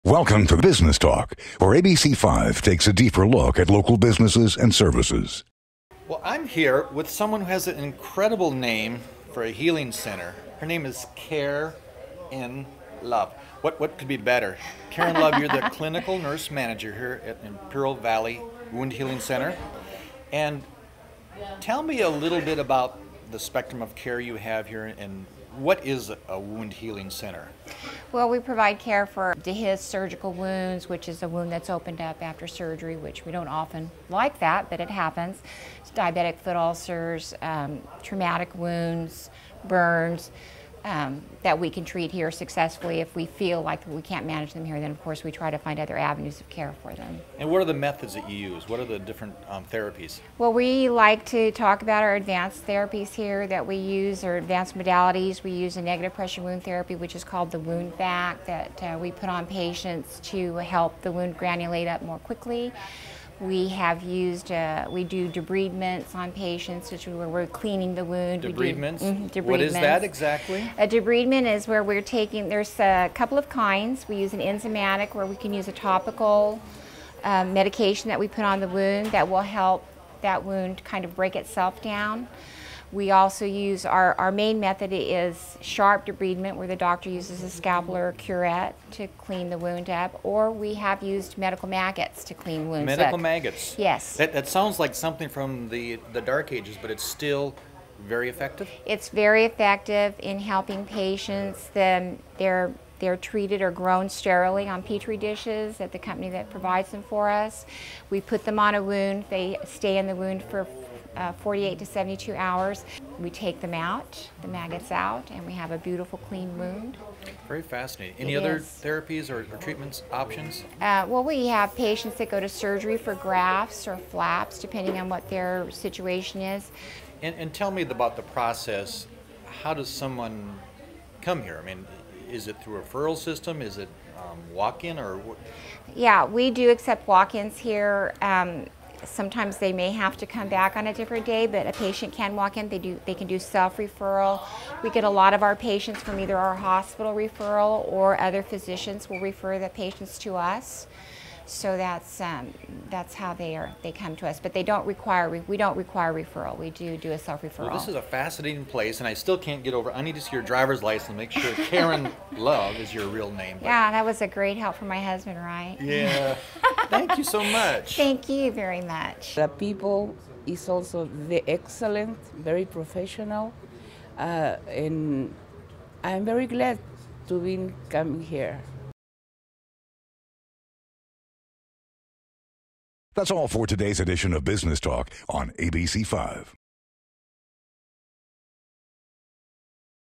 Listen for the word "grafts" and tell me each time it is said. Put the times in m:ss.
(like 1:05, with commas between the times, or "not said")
2:03.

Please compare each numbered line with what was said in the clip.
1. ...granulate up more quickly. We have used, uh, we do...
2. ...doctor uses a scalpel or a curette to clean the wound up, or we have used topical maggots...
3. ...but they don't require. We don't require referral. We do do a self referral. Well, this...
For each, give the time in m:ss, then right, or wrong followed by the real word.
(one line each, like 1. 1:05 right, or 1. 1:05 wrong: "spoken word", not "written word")
1. 1:01 right
2. 1:26 wrong: "medical", not "topical"
3. 2:34 right.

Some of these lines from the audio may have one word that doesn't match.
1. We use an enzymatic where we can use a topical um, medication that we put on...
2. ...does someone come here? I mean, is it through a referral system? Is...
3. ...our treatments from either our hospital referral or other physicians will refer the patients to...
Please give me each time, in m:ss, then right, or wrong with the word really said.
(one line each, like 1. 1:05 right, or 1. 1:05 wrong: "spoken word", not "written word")
1. 1:14 right
2. 2:09 right
3. 2:25 wrong: "patients", not "treatments".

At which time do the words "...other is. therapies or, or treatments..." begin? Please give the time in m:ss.
1:58.